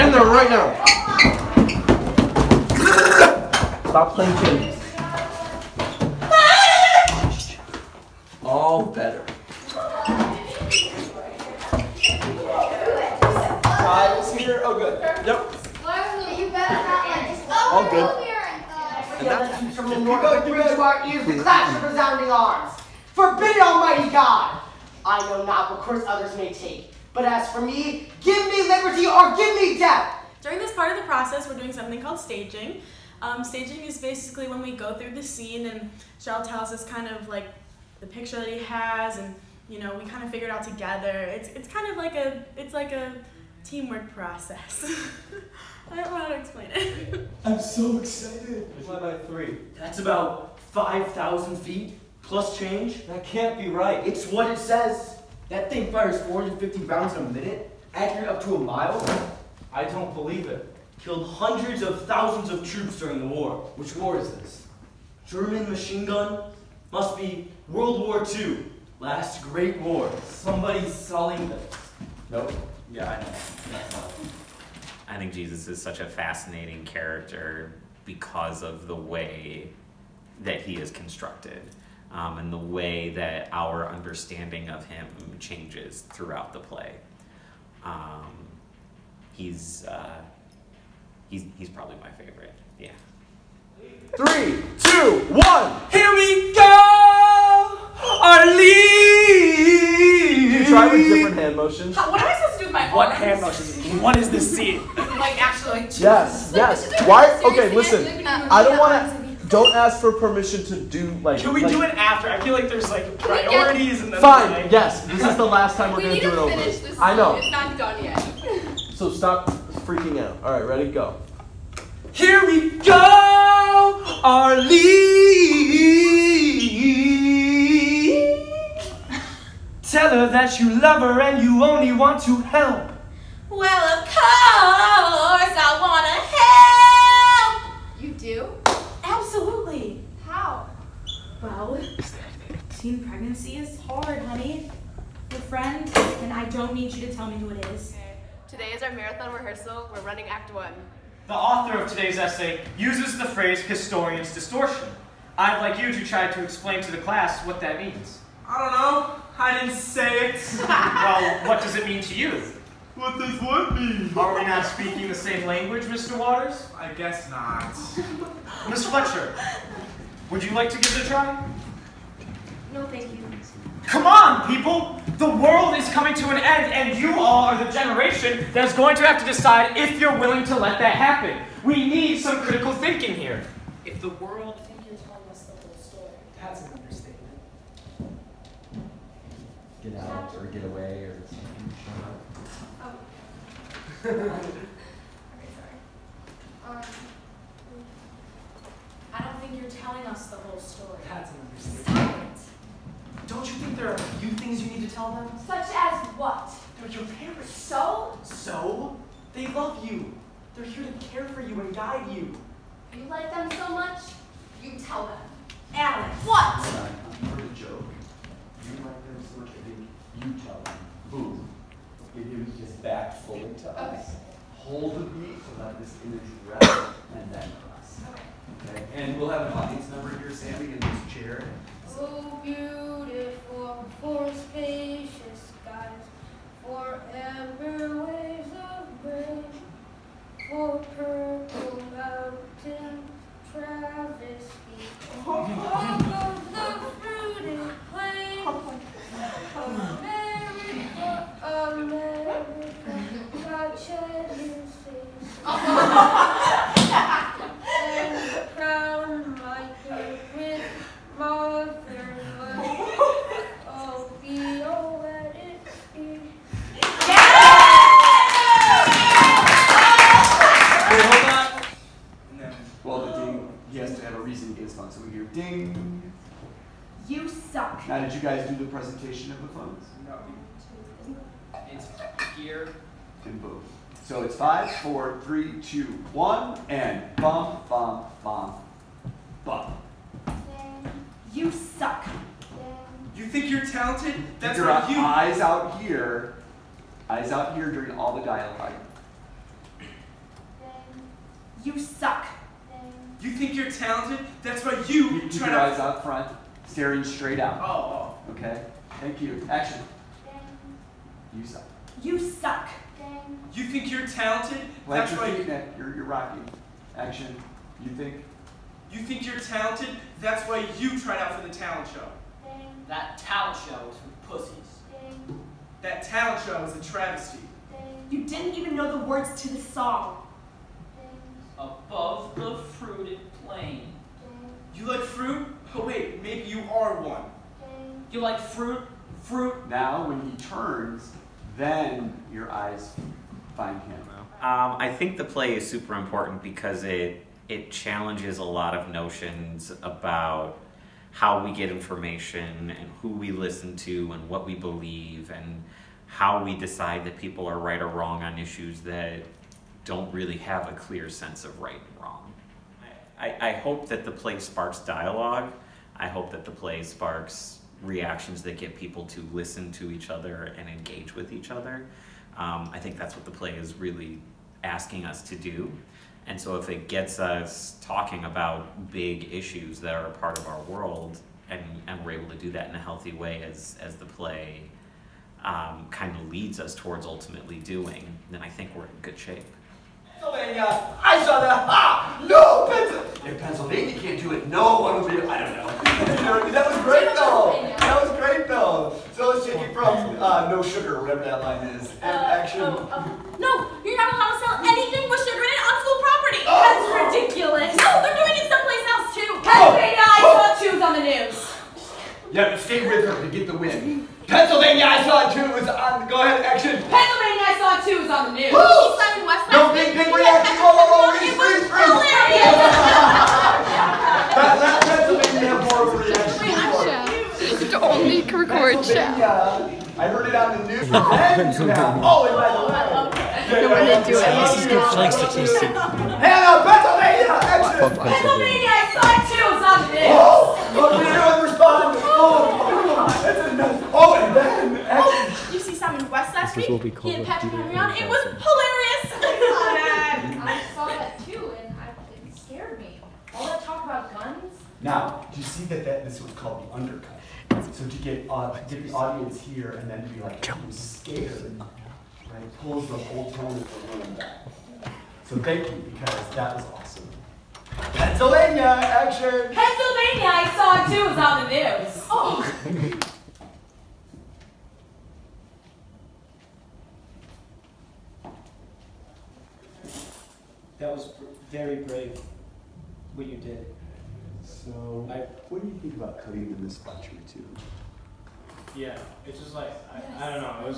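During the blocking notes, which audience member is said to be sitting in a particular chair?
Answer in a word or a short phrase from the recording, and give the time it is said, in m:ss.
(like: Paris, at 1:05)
Sammy, at 3:50.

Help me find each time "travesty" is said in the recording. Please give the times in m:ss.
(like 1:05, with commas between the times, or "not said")
4:03, 5:26.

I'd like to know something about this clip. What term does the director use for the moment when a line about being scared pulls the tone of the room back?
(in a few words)
The undercut.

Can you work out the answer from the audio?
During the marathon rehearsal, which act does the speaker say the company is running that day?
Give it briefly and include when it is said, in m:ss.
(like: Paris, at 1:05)
Act 1, at 2:30.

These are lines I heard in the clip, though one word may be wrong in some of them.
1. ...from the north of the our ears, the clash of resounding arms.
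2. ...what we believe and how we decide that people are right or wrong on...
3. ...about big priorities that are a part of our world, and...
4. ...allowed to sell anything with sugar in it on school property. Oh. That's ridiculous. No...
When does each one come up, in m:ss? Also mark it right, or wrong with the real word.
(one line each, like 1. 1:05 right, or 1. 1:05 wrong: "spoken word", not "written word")
1. 0:19 right
2. 5:54 right
3. 6:18 wrong: "issues", not "priorities"
4. 6:44 right.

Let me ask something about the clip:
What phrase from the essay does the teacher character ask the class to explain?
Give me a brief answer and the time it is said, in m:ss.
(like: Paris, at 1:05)
Historian's distortion, at 2:33.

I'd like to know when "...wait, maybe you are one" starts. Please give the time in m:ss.
5:35.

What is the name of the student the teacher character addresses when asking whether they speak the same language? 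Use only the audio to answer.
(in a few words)
Mr. Waters.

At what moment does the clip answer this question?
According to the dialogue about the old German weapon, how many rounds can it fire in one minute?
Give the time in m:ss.
0:56.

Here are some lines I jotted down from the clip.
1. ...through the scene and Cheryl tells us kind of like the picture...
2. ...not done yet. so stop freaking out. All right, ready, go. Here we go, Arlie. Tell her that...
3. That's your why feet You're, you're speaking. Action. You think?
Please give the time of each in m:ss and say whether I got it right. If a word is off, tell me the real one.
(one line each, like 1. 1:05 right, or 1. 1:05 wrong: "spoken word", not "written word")
1. 0:34 right
2. 1:57 right
3. 5:14 wrong: "rocking", not "speaking".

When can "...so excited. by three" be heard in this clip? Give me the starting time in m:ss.
0:47.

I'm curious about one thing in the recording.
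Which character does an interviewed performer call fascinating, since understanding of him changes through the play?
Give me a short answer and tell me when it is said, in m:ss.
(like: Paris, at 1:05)
Jesus, at 1:15.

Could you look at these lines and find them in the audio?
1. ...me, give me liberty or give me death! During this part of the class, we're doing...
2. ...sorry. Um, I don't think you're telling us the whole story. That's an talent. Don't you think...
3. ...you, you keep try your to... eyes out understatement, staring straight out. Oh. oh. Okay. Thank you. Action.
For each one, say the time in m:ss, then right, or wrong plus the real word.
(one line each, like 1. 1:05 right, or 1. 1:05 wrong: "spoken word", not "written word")
1. 0:27 wrong: "process", not "class"
2. 3:15 wrong: "understatement", not "talent"
3. 5:04 wrong: "front", not "understatement".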